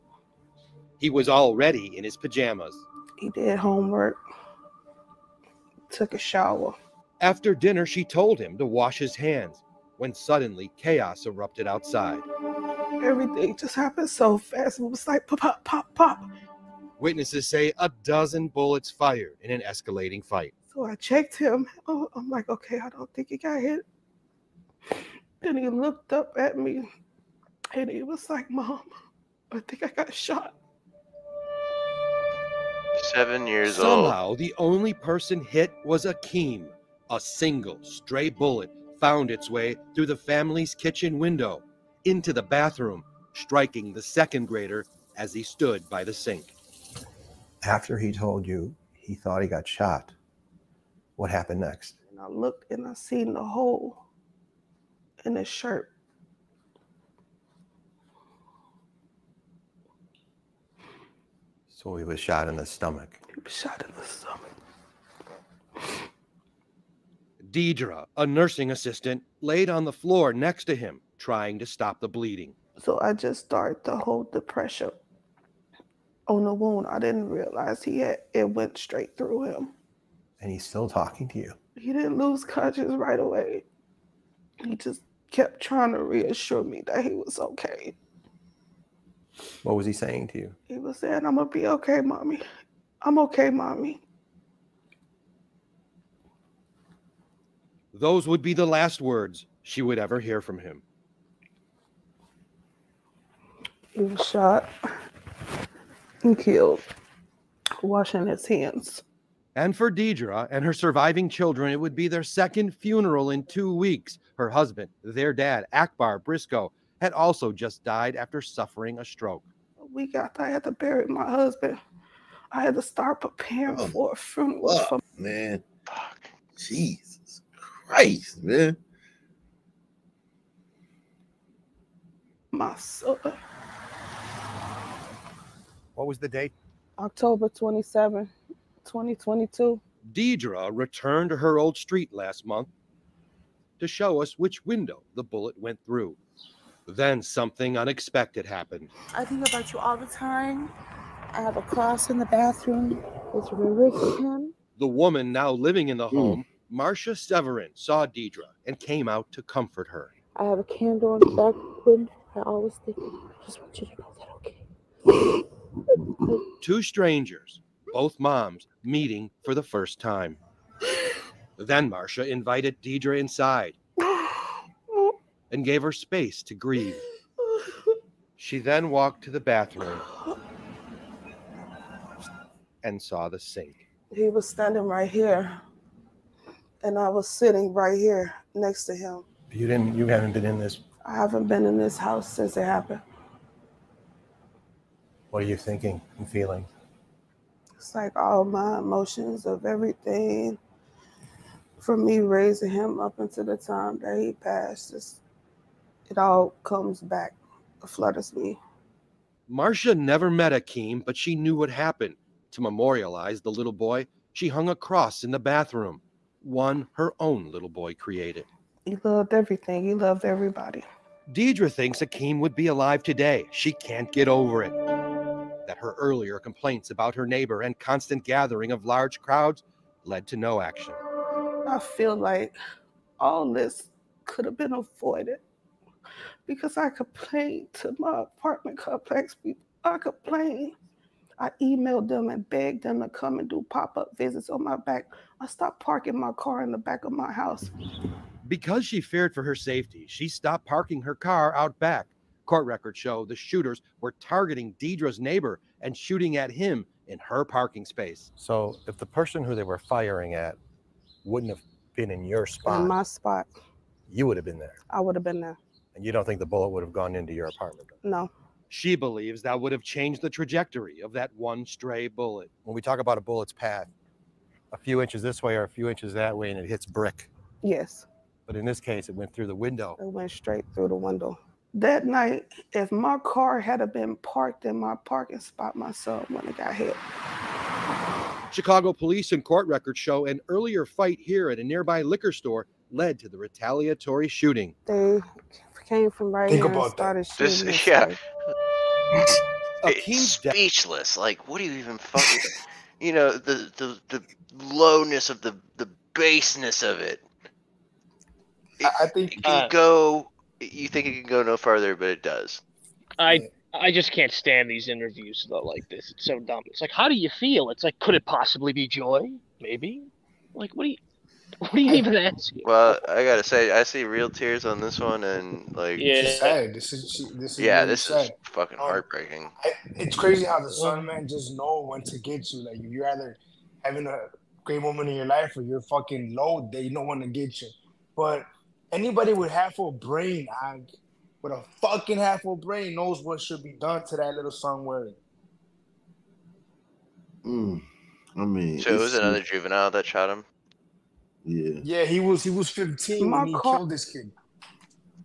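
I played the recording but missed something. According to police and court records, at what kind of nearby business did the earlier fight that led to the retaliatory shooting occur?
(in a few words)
Liquor store.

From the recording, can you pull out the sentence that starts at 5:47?
Mm, I mean, so it was another juvenile that shot him.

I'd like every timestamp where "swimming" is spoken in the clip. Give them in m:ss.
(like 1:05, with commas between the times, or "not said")
not said.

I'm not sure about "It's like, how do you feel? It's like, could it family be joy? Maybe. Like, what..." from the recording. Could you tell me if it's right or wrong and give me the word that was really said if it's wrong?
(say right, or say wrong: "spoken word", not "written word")
wrong: "possibly", not "family".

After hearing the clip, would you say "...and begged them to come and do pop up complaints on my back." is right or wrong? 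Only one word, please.
wrong.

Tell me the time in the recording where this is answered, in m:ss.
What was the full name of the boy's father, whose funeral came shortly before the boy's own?
1:55.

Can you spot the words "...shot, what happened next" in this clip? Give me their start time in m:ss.
0:49.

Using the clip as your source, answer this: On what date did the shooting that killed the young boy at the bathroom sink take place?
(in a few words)
October 27, 2022.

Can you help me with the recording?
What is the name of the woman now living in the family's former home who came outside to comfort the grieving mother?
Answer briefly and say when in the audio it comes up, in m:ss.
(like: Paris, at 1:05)
Marcia Severin, at 2:36.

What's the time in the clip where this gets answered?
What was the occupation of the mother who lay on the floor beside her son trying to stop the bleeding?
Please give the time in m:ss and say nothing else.
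1:08.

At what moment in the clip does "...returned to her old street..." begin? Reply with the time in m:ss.
2:20.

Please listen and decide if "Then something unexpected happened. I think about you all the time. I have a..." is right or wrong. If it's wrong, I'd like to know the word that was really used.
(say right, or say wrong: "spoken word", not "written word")
right.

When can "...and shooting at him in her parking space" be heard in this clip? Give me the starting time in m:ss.
4:15.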